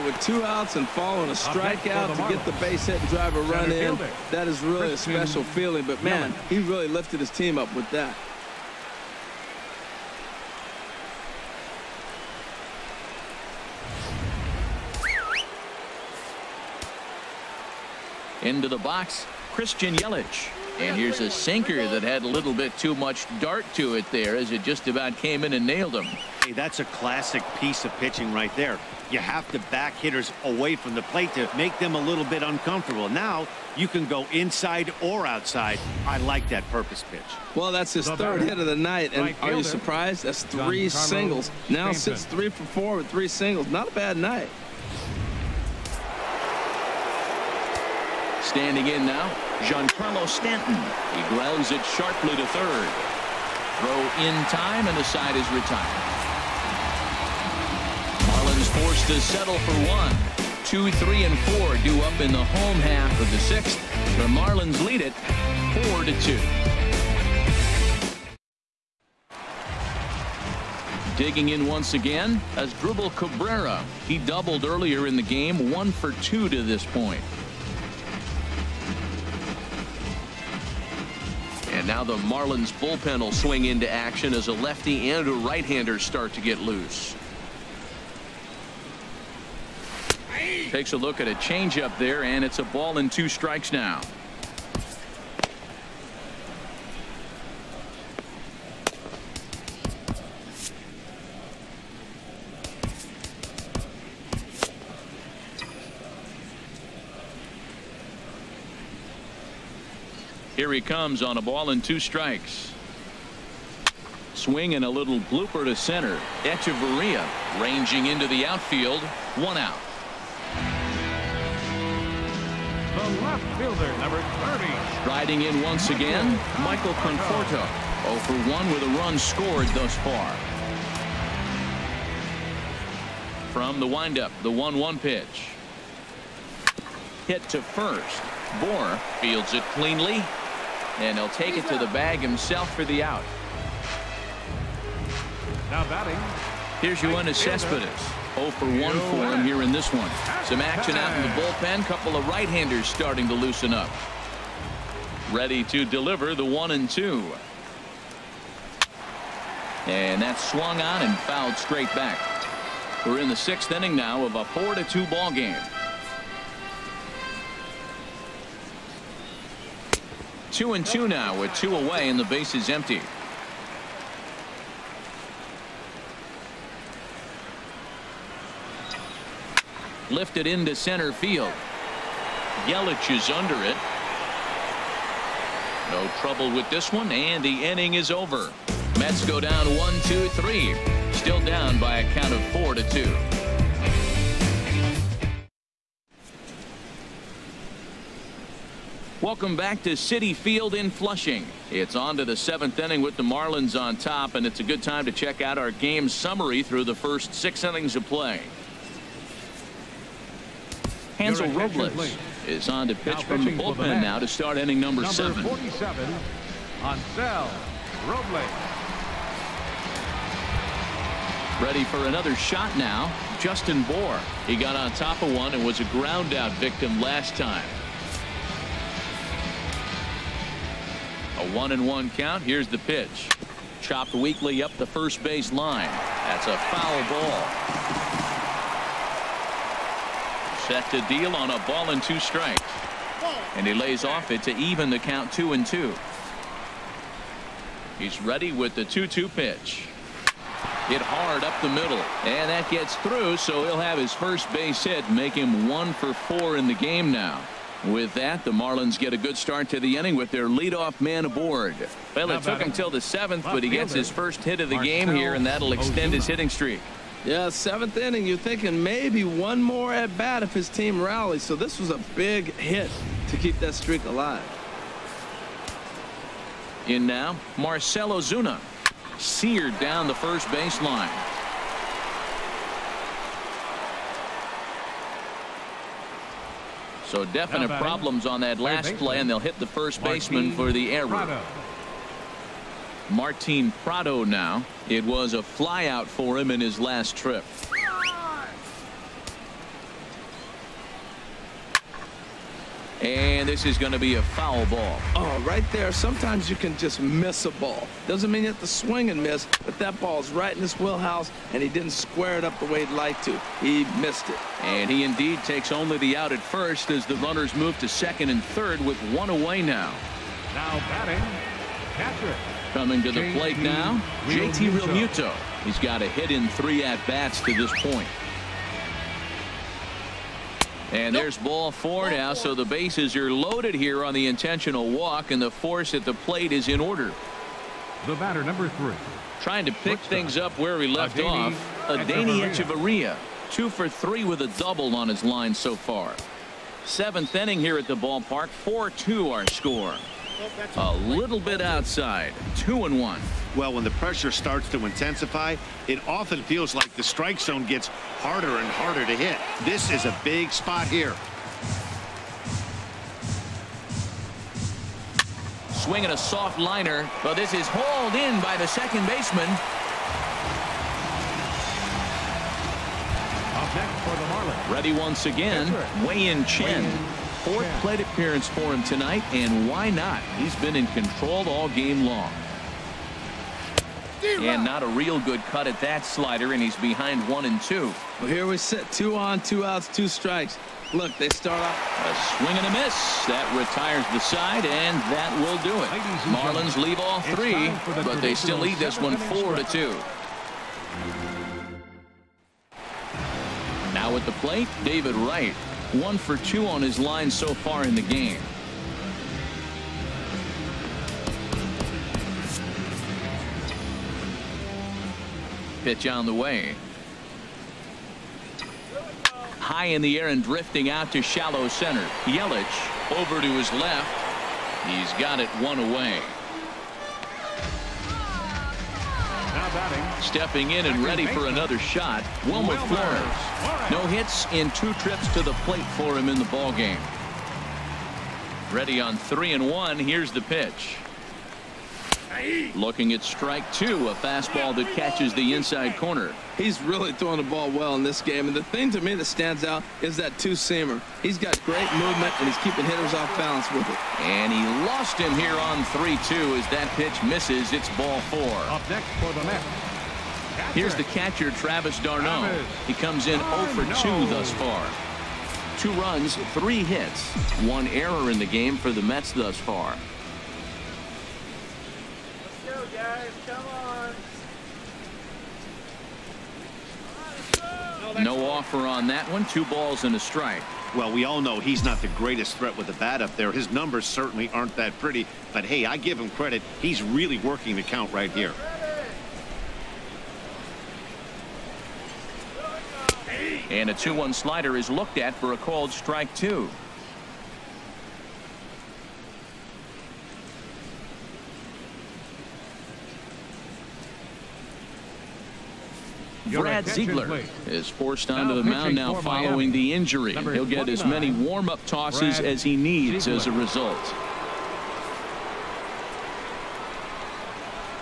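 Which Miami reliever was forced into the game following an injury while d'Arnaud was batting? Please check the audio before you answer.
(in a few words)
Brad Ziegler.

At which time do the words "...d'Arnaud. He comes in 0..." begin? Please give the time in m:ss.
7:42.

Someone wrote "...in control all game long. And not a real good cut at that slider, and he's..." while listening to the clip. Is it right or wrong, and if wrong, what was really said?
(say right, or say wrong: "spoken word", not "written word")
right.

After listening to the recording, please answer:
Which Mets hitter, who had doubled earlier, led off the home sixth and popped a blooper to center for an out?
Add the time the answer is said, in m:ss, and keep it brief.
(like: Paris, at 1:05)
Asdrubal Cabrera, at 1:12.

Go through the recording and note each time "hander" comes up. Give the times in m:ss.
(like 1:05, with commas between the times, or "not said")
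1:25, 2:32.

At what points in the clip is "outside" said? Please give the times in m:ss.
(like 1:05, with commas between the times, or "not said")
0:35, 5:51.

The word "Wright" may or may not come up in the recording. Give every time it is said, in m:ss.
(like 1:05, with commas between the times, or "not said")
6:45.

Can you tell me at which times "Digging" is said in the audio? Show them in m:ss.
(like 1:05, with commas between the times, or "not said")
1:11.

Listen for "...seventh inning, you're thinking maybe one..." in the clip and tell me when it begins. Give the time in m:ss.
4:27.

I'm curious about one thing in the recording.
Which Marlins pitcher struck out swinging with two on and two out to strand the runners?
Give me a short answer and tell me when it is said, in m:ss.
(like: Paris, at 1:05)
Wei-Yin Chen, at 6:16.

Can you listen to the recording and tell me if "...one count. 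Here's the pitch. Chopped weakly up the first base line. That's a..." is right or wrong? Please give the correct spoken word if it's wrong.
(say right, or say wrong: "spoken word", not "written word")
right.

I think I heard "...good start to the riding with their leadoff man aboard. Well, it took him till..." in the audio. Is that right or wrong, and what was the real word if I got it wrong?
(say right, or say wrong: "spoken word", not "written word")
wrong: "inning", not "riding".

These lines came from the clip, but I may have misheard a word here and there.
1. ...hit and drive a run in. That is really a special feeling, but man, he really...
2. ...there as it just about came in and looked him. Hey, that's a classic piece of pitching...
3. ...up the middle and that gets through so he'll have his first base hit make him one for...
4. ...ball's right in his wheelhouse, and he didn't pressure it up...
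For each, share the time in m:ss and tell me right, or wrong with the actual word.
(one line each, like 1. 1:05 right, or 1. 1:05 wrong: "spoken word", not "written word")
1. 0:02 right
2. 0:24 wrong: "nailed", not "looked"
3. 4:11 right
4. 5:10 wrong: "square", not "pressure".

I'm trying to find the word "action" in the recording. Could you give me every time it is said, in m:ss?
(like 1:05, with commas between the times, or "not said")
1:23, 2:30.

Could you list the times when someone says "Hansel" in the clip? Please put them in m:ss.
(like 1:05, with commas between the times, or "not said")
3:31, 3:36.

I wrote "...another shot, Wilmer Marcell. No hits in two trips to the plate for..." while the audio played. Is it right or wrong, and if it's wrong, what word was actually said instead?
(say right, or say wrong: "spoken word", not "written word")
wrong: "Flores", not "Marcell".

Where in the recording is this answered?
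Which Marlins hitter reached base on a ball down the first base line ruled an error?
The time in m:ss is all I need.
4:37.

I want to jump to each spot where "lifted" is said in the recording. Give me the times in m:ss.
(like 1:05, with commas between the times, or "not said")
0:06, 3:00.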